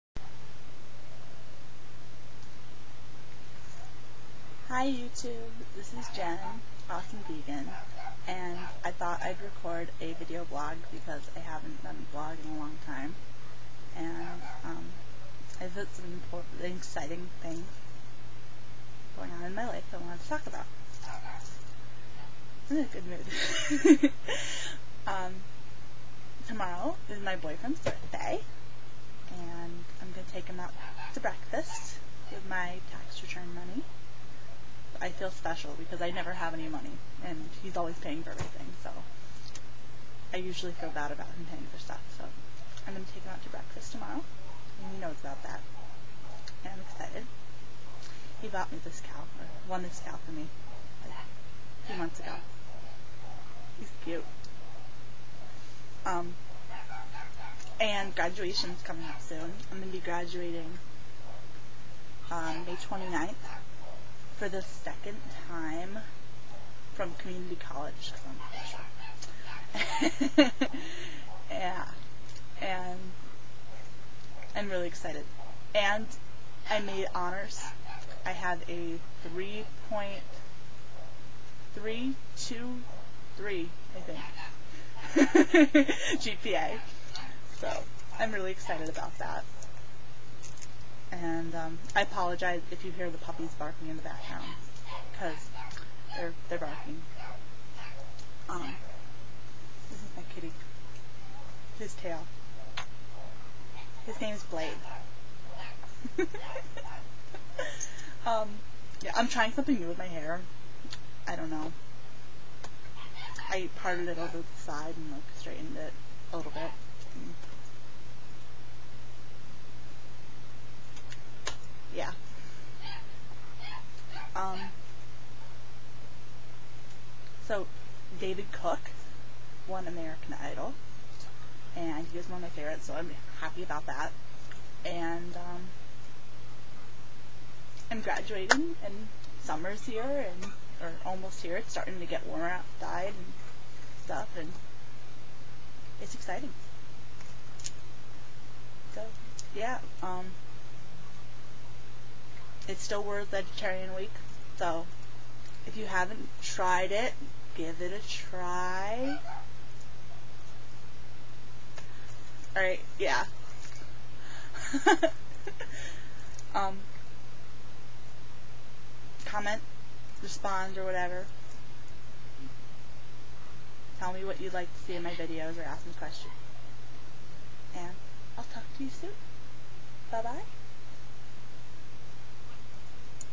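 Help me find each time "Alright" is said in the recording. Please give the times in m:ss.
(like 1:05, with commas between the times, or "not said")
2:42.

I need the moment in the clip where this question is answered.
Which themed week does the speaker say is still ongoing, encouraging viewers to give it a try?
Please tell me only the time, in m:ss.
2:33.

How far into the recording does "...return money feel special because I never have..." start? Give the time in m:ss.
0:33.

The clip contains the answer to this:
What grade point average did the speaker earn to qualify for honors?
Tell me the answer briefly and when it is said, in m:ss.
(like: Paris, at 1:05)
3.323, at 1:19.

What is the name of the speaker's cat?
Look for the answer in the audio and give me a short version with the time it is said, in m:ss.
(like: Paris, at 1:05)
Blade, at 1:44.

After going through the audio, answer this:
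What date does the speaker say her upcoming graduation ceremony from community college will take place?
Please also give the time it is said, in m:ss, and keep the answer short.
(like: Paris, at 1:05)
May 29th, at 1:02.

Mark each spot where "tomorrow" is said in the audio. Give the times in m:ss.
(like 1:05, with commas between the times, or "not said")
0:26, 0:43.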